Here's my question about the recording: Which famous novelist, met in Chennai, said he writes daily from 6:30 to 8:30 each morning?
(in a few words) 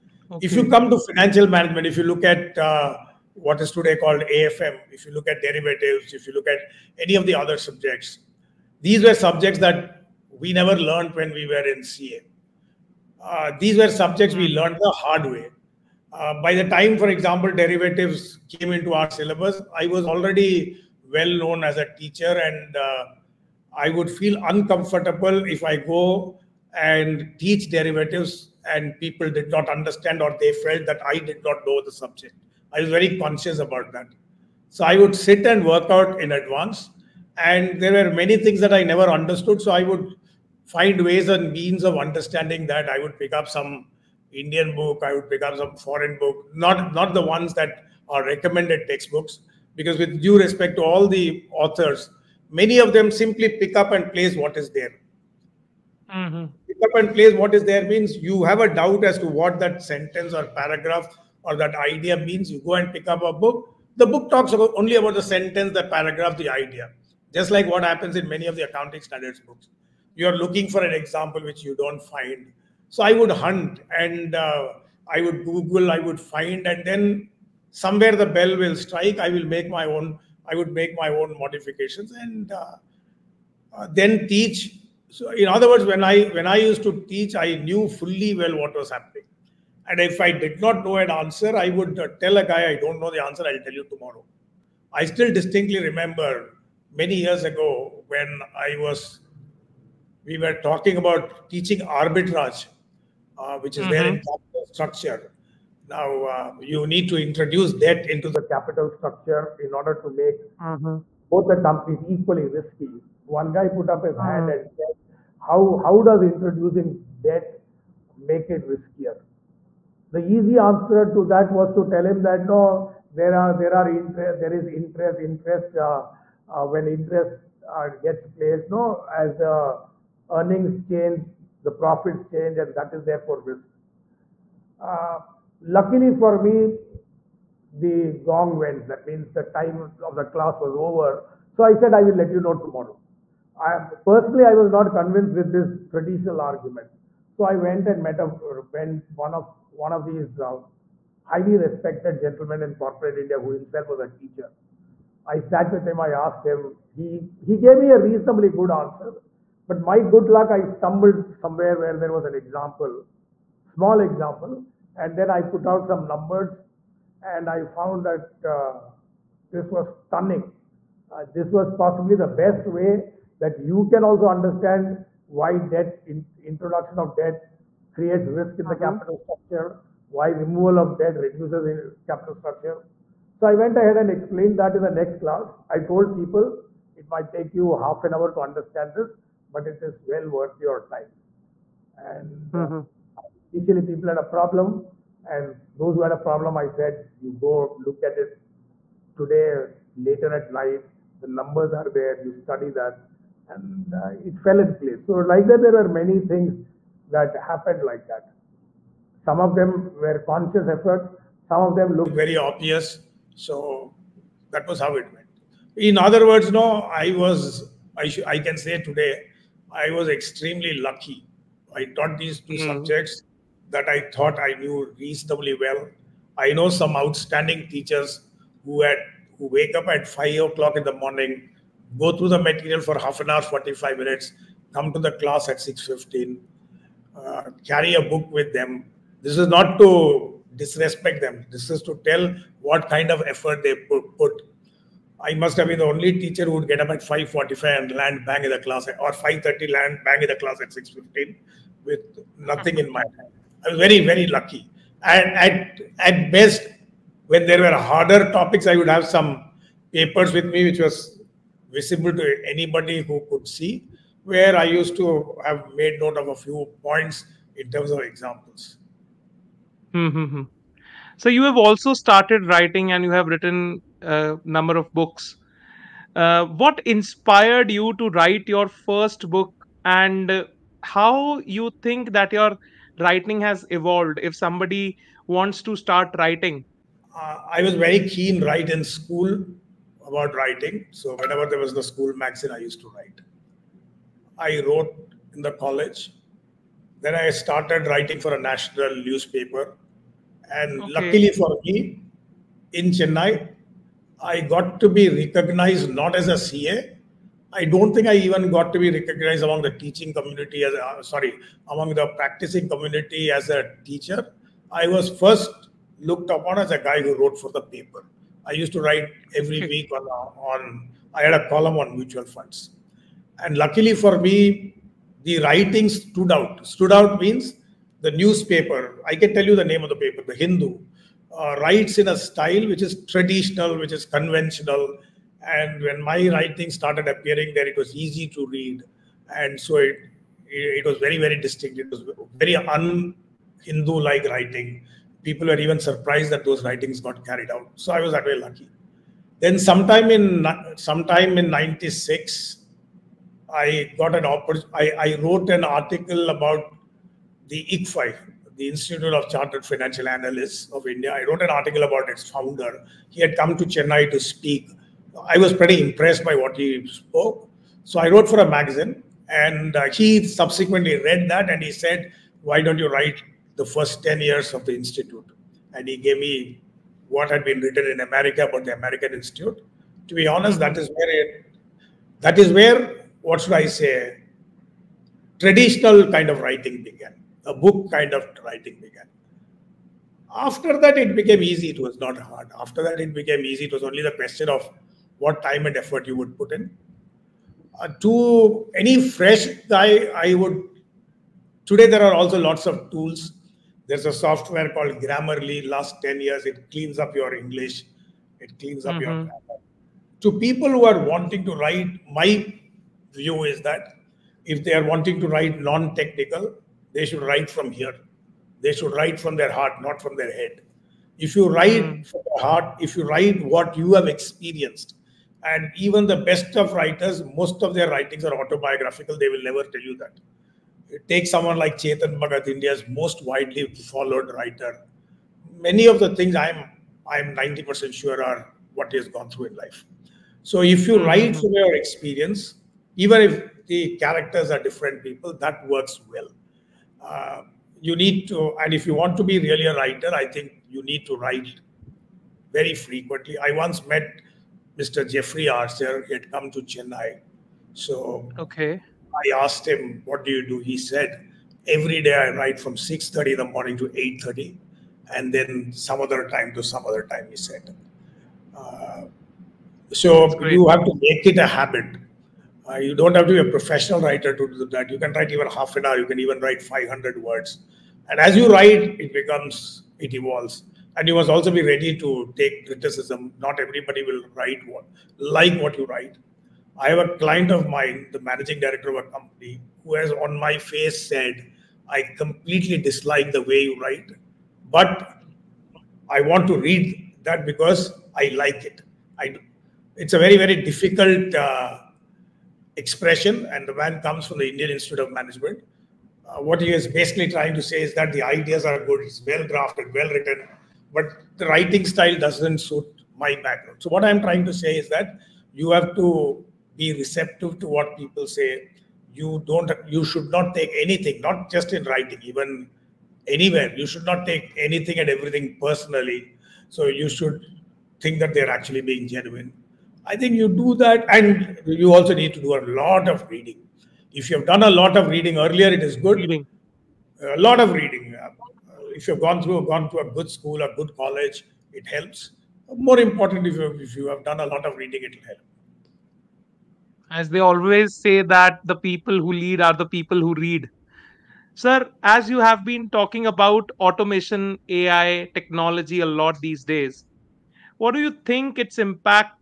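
Jeffrey Archer.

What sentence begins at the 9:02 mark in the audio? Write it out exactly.
More important, if you, if you have done a lot of reading, it will help.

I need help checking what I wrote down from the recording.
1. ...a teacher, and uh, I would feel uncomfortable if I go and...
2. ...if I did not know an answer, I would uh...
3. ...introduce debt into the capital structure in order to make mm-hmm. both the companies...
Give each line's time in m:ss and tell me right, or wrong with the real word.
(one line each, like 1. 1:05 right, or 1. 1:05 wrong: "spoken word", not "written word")
1. 0:21 right
2. 1:29 right
3. 1:47 right.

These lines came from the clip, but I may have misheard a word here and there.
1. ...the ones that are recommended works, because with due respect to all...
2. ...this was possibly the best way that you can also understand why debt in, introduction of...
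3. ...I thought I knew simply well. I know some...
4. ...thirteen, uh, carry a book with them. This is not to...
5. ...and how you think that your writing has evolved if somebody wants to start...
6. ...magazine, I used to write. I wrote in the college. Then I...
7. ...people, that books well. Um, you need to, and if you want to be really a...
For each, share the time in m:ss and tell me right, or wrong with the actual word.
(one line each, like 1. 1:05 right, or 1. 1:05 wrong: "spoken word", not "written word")
1. 0:47 wrong: "textbooks", not "works"
2. 2:51 right
3. 3:43 wrong: "reasonably", not "simply"
4. 3:55 wrong: "fifteen", not "thirteen"
5. 4:39 right
6. 4:52 right
7. 7:25 wrong: "works", not "books".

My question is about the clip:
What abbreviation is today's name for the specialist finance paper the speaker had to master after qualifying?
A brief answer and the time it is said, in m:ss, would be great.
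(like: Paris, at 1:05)
AFM, at 0:04.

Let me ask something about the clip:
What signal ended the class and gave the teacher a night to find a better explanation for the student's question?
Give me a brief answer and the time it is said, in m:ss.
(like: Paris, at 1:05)
The gong, at 2:17.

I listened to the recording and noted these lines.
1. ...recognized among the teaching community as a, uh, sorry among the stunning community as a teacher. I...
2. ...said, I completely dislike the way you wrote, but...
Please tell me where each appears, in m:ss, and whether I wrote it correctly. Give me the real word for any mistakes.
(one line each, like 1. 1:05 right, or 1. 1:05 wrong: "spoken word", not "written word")
1. 5:08 wrong: "practicing", not "stunning"
2. 8:11 wrong: "write", not "wrote".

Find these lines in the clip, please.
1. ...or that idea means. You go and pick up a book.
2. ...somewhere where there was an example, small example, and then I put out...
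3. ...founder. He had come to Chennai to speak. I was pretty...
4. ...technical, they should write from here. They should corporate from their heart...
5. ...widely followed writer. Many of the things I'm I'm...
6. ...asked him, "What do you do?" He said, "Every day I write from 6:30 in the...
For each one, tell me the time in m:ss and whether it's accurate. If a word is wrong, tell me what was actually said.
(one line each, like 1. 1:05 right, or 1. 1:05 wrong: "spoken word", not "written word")
1. 1:01 right
2. 2:41 right
3. 6:02 right
4. 6:55 wrong: "write", not "corporate"
5. 7:13 right
6. 7:39 right.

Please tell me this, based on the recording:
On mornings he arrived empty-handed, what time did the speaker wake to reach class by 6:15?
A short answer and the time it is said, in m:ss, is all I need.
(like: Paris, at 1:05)
5:45, at 4:07.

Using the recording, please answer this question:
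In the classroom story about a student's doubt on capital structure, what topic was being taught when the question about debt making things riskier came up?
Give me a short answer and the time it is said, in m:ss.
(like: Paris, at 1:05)
Arbitrage, at 1:41.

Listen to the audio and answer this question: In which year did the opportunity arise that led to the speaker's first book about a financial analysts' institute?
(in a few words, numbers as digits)
1996.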